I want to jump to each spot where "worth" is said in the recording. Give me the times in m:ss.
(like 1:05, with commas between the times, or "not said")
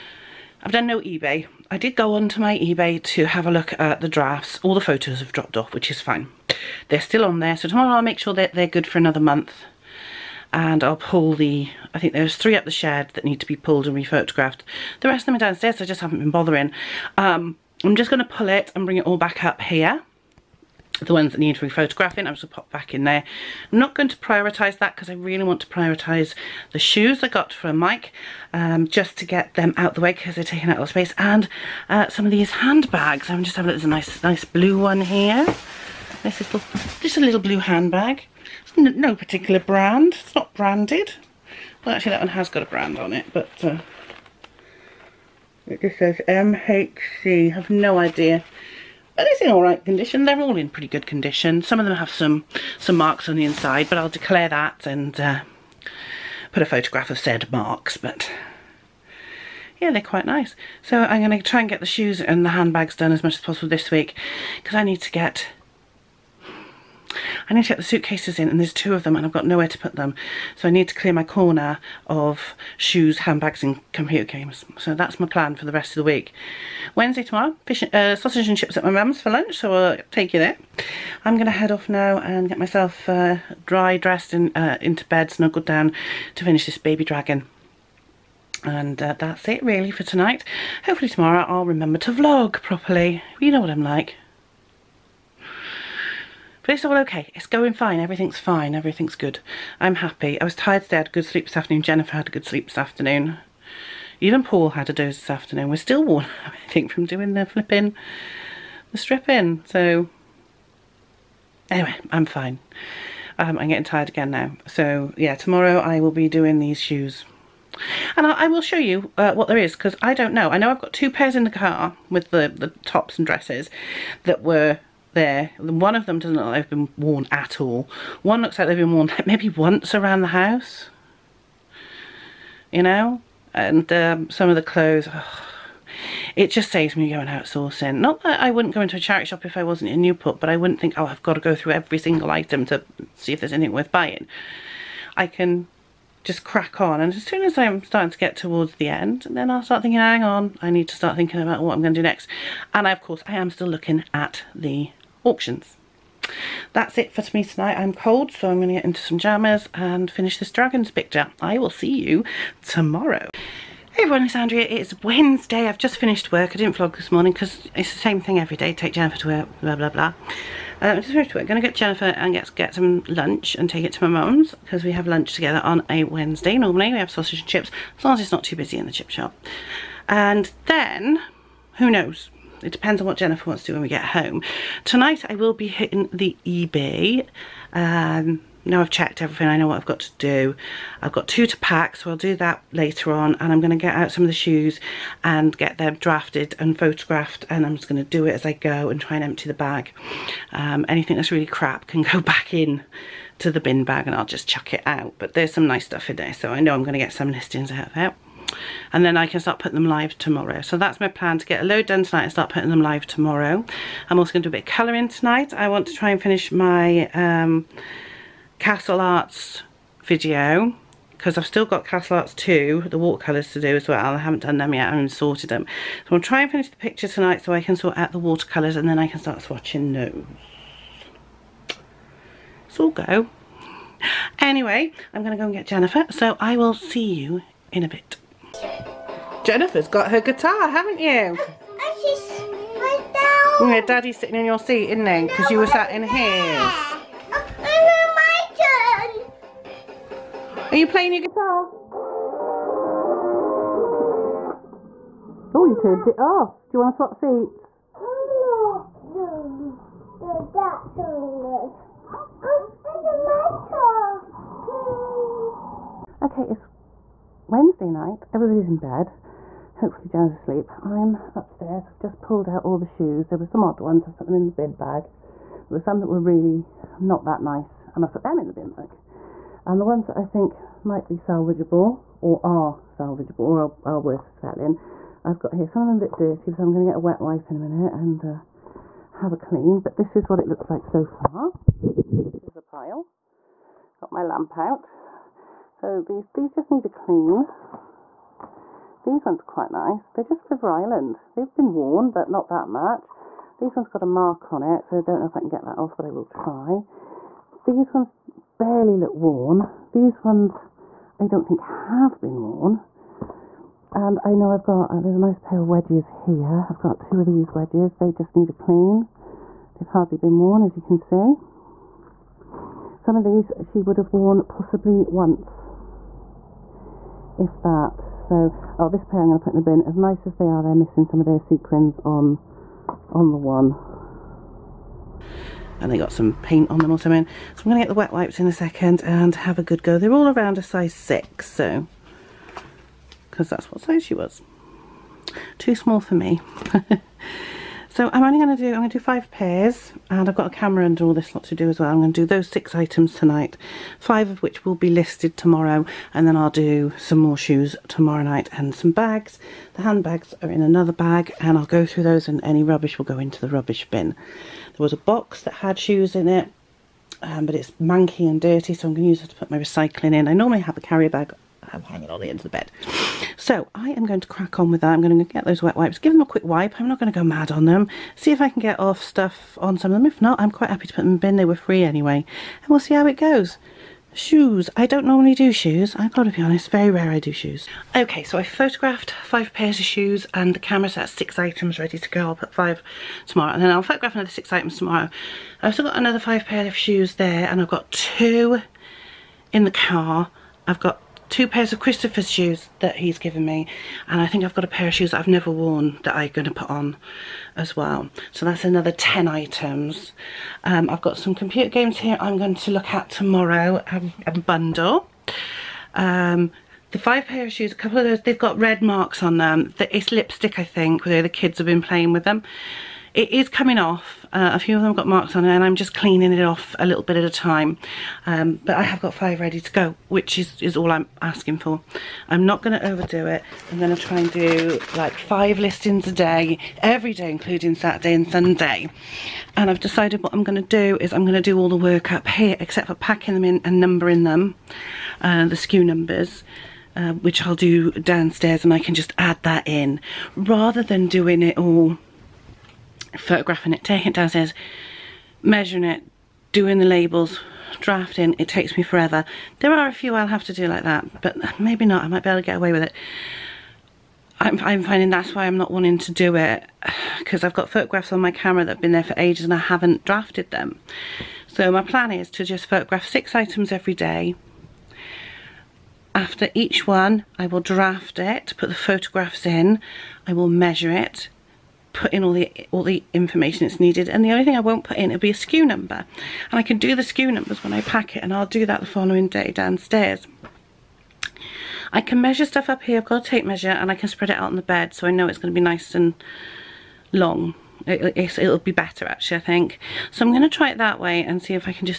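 2:23, 4:44.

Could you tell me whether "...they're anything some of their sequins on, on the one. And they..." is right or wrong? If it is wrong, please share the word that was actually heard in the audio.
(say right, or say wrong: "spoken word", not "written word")
wrong: "missing", not "anything".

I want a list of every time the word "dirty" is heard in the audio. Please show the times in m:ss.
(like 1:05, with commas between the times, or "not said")
4:46, 6:08.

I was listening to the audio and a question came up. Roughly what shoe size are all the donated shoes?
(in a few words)
6.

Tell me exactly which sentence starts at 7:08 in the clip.
Um, but I have got five ready to go, which is, is all I'm asking for.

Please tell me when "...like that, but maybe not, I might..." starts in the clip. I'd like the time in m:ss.
7:40.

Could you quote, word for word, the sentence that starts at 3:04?
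Tonight I will be hitting the eBay.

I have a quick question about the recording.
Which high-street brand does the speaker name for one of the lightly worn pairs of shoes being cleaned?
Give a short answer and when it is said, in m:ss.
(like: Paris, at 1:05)
River Island, at 5:00.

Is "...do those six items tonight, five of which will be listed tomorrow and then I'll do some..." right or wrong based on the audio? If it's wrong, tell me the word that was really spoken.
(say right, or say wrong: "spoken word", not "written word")
right.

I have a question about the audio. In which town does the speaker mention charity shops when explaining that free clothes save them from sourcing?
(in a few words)
Newport.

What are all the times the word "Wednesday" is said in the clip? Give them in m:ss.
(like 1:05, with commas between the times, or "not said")
1:16, 2:45, 2:56, 4:27.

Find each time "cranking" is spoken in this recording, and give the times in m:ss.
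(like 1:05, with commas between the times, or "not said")
not said.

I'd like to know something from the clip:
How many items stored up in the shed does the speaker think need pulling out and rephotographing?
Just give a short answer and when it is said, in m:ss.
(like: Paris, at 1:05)
3, at 0:12.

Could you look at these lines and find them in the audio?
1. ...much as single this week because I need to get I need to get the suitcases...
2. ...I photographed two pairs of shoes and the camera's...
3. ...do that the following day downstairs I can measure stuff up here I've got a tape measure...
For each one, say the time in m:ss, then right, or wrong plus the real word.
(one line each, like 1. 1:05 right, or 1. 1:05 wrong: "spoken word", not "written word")
1. 1:03 wrong: "possible", not "single"
2. 6:28 wrong: "five", not "two"
3. 8:08 right.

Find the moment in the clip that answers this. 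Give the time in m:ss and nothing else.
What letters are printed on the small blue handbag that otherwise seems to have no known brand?
0:46.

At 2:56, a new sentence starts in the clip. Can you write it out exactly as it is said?
Normally we have sausage and chips as long as it's not too busy in the chip shop.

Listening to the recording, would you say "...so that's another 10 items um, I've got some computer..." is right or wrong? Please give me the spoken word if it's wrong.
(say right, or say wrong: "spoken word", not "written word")
right.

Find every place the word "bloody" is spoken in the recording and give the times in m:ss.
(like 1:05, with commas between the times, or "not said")
not said.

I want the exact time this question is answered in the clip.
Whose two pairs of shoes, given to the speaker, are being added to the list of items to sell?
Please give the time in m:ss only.
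6:41.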